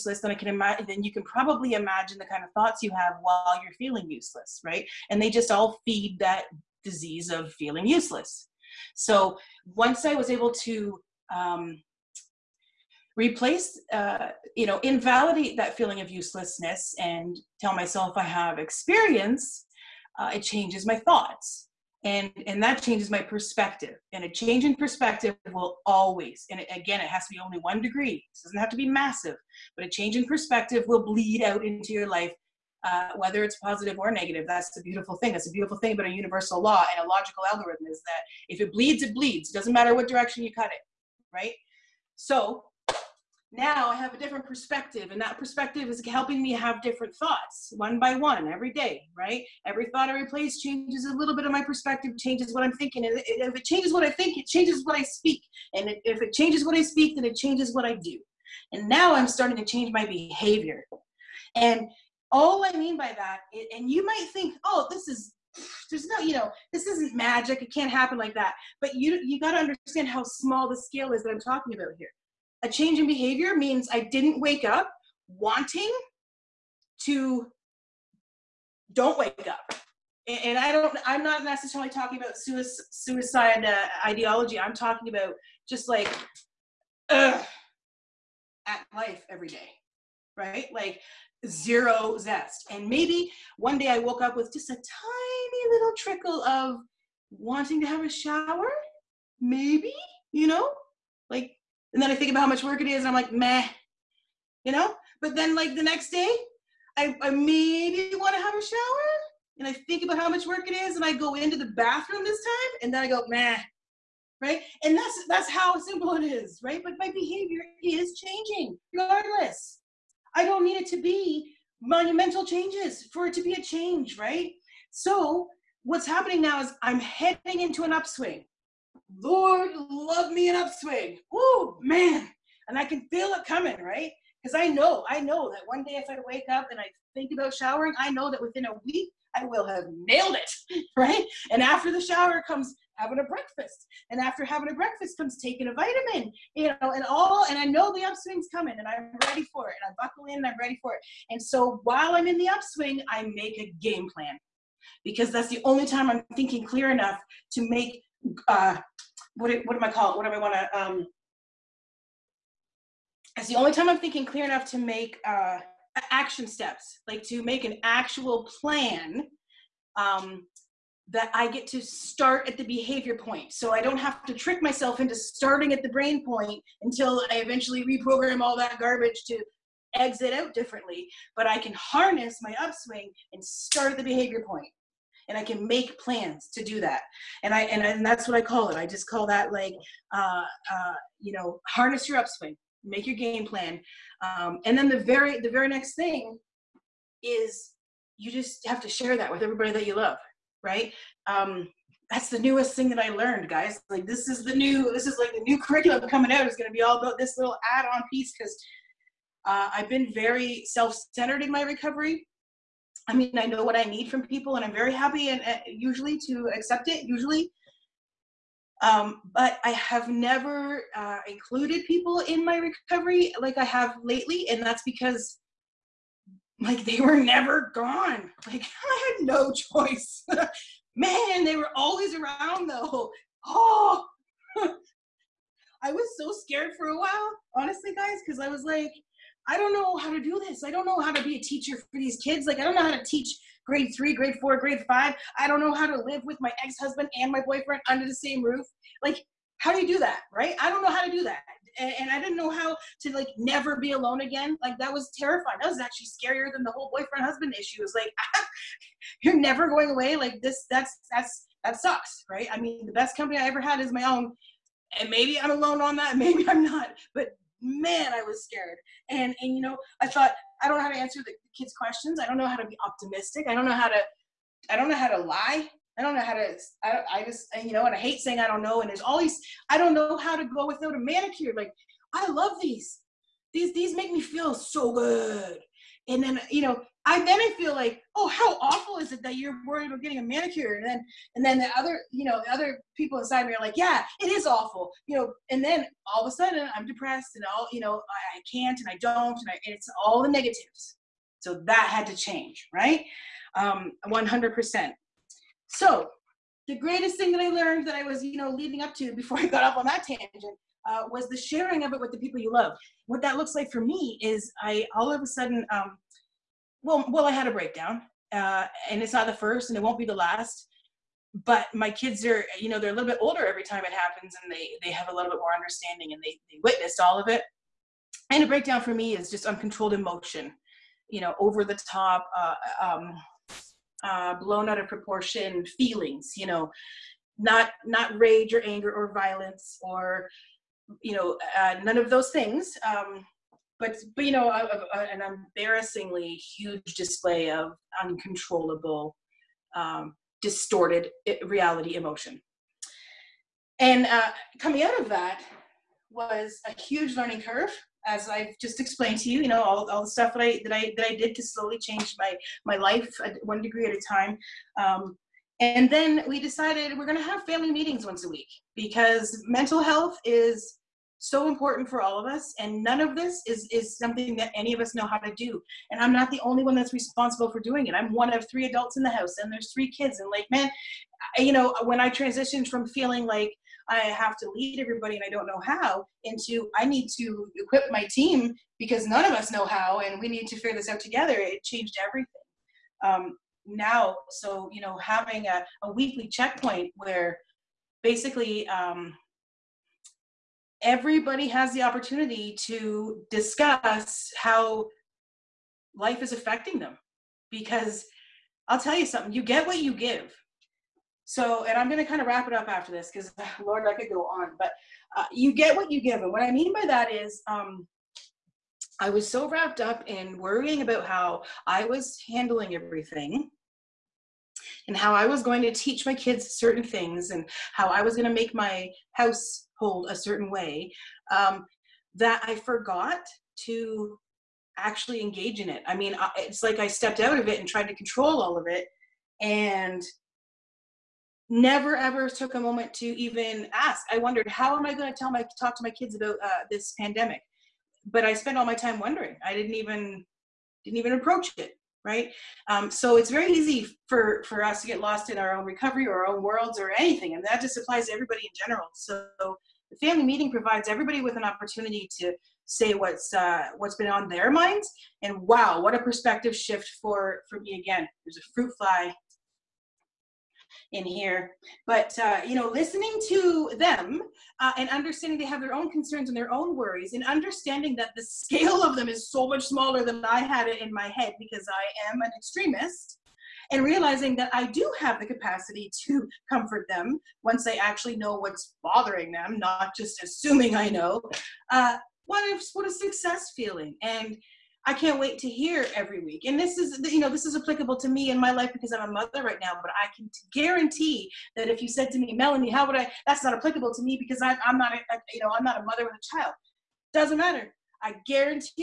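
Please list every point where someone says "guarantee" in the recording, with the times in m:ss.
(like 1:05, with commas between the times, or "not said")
8:20, 8:28.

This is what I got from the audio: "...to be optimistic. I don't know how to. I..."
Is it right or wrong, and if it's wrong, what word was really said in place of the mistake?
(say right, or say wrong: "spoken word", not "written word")
right.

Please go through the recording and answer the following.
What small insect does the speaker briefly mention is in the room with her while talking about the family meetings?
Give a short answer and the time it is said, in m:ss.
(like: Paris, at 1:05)
fruit fly, at 7:48.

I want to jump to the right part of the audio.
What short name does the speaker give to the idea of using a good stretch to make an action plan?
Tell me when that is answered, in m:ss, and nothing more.
3:11.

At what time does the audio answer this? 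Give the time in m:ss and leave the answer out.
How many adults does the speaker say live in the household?
6:18.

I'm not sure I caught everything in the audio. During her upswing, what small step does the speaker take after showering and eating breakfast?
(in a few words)
taking a vitamin.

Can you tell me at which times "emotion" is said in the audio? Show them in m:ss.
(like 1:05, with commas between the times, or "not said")
5:29, 5:51.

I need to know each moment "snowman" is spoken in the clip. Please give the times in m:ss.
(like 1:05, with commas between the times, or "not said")
not said.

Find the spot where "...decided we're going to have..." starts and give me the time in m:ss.
6:06.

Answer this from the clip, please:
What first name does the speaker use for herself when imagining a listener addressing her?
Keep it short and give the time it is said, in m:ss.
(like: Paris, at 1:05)
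Melanie, at 8:22.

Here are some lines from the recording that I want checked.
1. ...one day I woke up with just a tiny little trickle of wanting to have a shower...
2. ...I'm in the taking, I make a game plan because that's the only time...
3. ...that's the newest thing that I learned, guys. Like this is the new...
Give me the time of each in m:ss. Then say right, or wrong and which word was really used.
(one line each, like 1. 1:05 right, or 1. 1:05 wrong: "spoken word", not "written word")
1. 1:33 right
2. 2:32 wrong: "upswing", not "taking"
3. 3:22 right.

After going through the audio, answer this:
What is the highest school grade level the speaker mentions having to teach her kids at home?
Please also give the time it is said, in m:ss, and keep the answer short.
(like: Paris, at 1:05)
grade 5, at 4:04.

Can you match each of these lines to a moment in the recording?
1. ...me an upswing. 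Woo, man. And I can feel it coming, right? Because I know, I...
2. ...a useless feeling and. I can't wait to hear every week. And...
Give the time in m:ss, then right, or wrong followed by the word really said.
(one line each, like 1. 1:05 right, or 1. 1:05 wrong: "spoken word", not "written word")
1. 2:10 right
2. 8:12 wrong: "success", not "useless".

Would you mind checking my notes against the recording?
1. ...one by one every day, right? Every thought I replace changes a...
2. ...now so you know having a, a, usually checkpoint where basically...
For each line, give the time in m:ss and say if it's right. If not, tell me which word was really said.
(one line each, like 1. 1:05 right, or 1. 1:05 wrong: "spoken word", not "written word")
1. 0:47 right
2. 6:33 wrong: "weekly", not "usually".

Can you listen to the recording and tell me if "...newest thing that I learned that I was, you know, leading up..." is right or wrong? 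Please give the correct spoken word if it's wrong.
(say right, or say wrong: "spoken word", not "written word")
wrong: "greatest", not "newest".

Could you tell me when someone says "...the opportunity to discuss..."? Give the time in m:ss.
6:41.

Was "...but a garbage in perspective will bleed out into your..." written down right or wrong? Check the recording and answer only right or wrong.
wrong.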